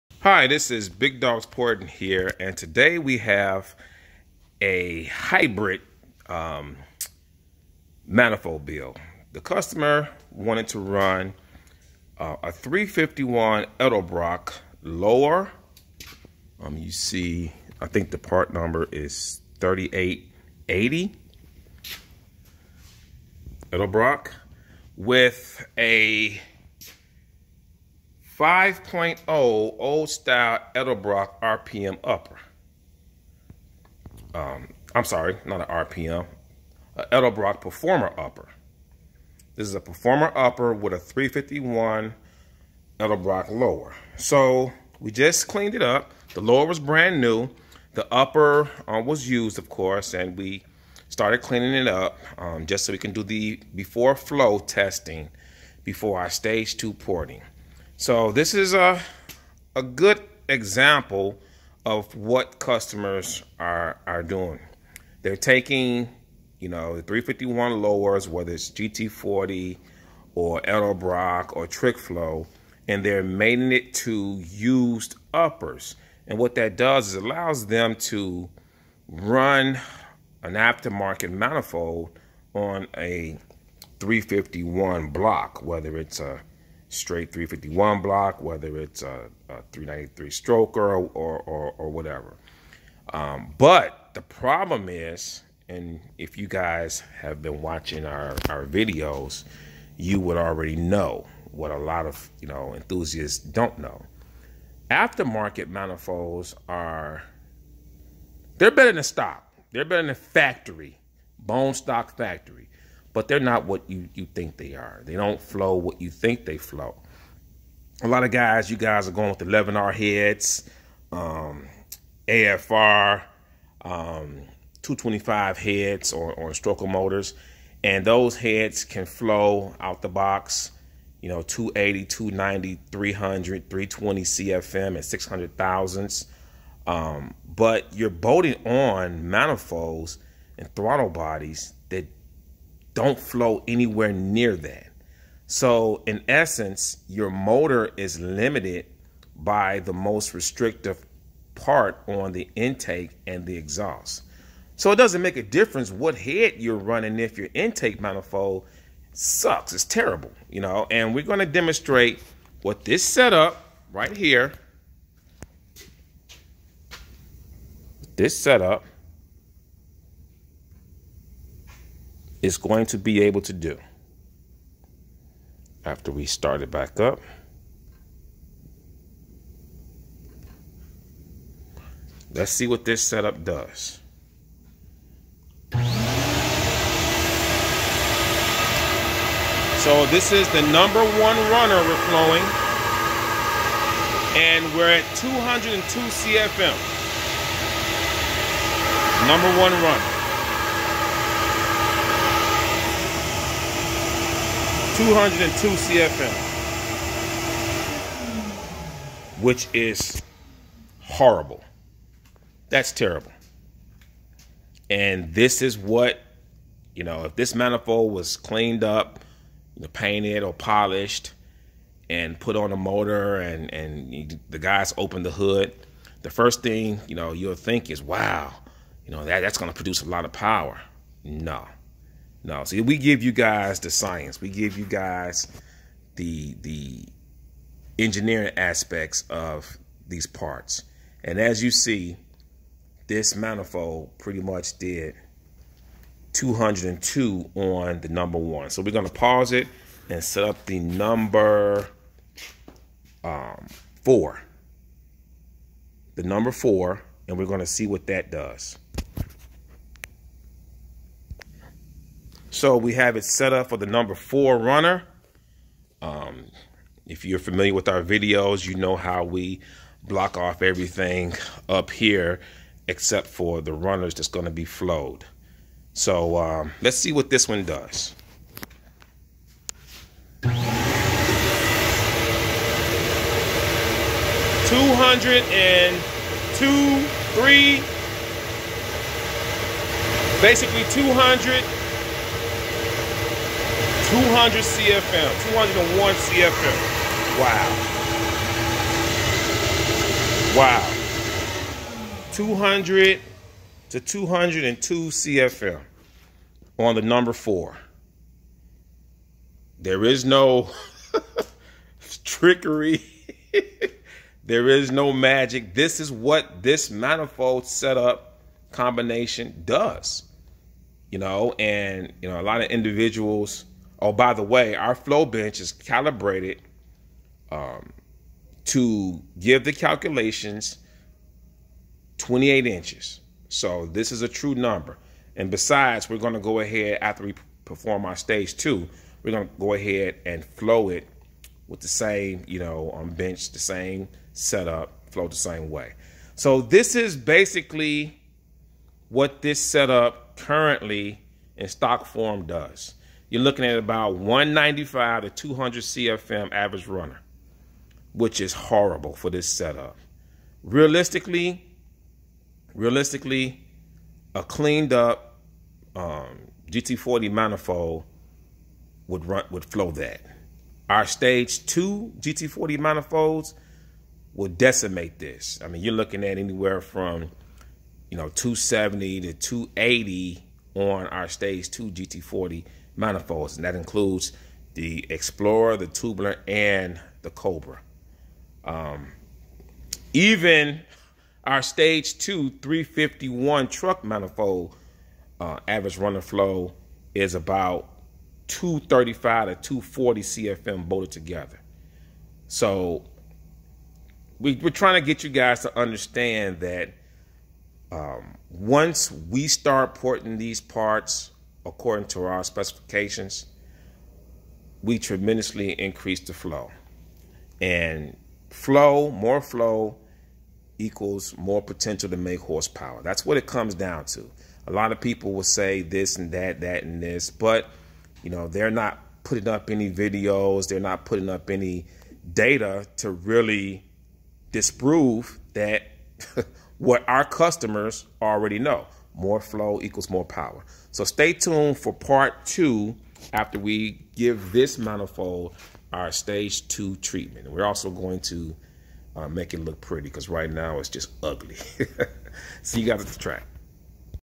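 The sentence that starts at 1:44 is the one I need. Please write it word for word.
Aftermarket manifolds are they're better than stock.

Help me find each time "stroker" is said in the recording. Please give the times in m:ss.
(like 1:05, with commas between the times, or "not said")
1:30, 2:06.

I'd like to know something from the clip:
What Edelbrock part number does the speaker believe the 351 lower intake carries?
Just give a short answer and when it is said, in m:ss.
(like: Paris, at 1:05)
3880, at 0:19.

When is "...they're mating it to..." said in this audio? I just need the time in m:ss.
1:13.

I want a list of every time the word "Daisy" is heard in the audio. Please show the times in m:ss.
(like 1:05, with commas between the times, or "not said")
not said.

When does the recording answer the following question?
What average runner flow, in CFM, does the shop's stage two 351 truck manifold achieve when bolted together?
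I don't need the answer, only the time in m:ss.
6:38.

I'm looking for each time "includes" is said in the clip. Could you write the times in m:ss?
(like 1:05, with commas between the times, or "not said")
6:23.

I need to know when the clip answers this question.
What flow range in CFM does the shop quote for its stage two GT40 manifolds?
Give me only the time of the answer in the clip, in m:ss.
6:18.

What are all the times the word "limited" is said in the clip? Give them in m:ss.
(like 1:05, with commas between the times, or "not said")
2:28.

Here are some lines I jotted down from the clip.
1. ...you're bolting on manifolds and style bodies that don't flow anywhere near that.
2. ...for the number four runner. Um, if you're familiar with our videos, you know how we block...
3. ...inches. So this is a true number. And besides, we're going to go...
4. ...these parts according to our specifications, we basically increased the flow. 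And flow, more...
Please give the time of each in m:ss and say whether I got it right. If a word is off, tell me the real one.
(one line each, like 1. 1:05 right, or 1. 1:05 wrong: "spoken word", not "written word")
1. 2:17 wrong: "throttle", not "style"
2. 4:23 right
3. 5:32 right
4. 6:50 wrong: "tremendously", not "basically".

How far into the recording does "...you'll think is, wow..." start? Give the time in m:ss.
3:47.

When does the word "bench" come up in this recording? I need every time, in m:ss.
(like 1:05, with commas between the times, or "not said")
5:25, 5:43.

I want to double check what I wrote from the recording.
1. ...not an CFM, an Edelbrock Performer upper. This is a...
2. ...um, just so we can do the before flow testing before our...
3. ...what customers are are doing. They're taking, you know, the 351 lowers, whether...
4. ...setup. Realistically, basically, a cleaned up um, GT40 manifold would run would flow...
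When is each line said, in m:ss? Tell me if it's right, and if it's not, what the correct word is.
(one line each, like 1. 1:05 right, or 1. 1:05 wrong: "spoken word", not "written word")
1. 0:35 wrong: "RPM", not "CFM"
2. 0:52 right
3. 1:02 right
4. 5:59 wrong: "realistically", not "basically".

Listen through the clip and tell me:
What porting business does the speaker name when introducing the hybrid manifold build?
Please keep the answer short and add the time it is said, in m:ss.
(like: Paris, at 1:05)
Big Dogs Porting, at 0:00.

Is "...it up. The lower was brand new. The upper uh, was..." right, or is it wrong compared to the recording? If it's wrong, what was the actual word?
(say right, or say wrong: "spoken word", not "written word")
right.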